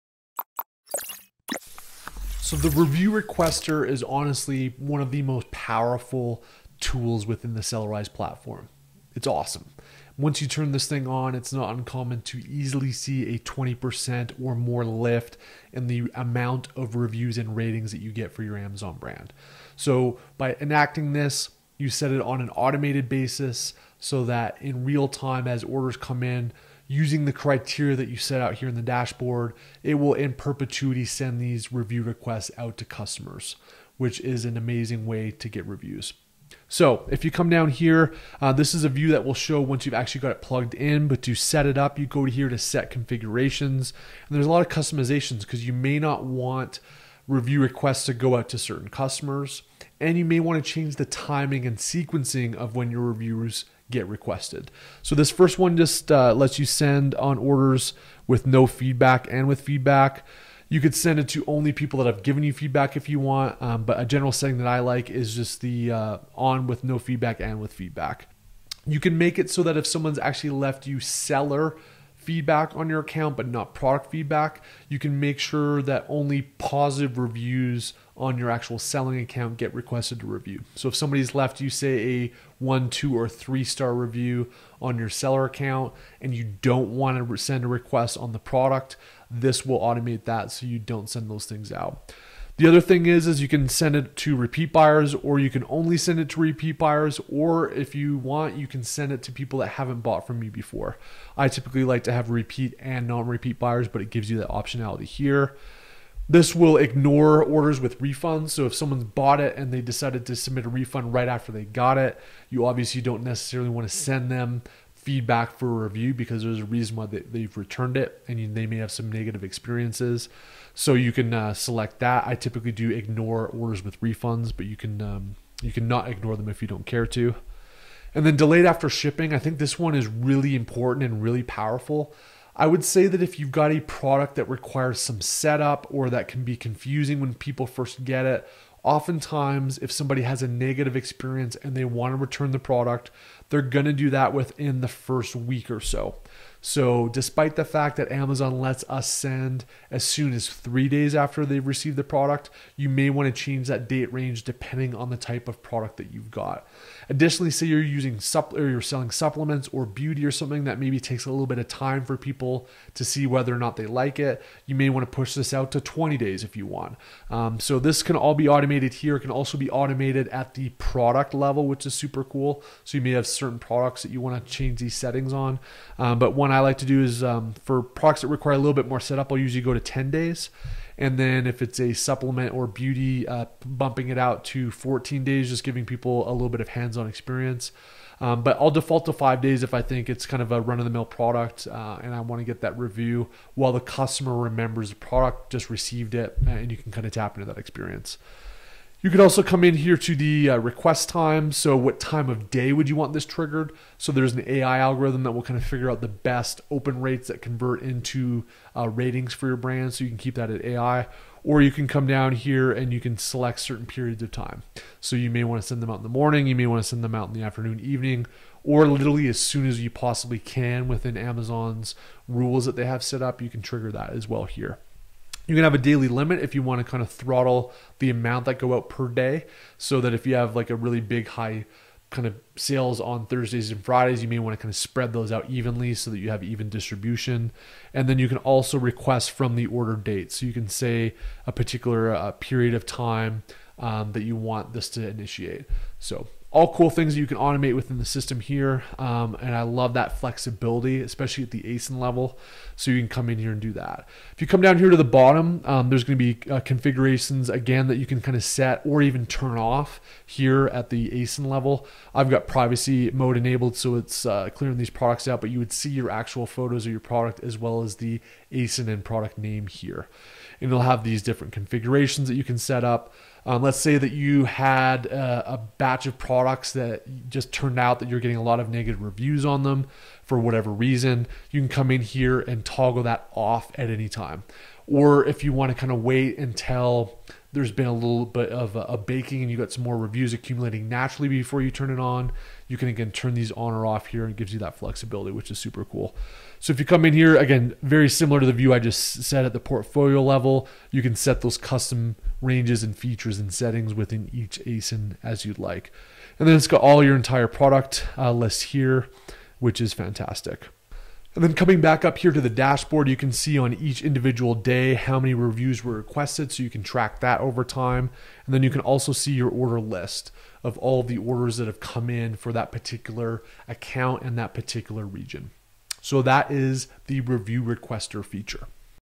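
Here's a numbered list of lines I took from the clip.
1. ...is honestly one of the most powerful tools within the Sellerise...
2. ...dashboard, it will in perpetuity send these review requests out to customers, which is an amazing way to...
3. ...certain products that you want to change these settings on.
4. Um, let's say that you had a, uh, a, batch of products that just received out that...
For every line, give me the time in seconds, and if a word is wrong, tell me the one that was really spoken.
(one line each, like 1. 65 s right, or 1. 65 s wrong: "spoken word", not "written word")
1. 3 s right
2. 28 s right
3. 173 s right
4. 273 s wrong: "turned", not "received".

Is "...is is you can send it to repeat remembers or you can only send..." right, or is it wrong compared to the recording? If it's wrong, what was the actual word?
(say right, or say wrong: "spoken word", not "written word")
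wrong: "buyers", not "remembers".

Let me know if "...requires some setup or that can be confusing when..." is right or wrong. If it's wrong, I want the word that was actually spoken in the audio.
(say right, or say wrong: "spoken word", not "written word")
right.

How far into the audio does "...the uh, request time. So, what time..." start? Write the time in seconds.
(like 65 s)
200 s.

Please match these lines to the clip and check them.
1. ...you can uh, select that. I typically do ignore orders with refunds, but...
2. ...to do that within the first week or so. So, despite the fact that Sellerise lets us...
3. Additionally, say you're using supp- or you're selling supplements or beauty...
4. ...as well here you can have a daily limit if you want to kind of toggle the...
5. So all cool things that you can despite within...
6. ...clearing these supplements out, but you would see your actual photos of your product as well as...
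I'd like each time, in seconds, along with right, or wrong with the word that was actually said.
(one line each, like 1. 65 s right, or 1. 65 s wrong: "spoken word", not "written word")
1. 120 s right
2. 143 s wrong: "Amazon", not "Sellerise"
3. 157 s right
4. 224 s wrong: "throttle", not "toggle"
5. 245 s wrong: "automate", not "despite"
6. 264 s wrong: "products", not "supplements".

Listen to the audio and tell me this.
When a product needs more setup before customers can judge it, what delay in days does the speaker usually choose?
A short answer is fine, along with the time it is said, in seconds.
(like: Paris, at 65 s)
10 days, at 179 s.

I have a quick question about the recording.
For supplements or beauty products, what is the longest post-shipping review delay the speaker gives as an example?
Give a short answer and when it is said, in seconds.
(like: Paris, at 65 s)
20 days, at 165 s.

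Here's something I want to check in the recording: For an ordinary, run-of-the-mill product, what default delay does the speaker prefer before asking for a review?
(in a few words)
5 days.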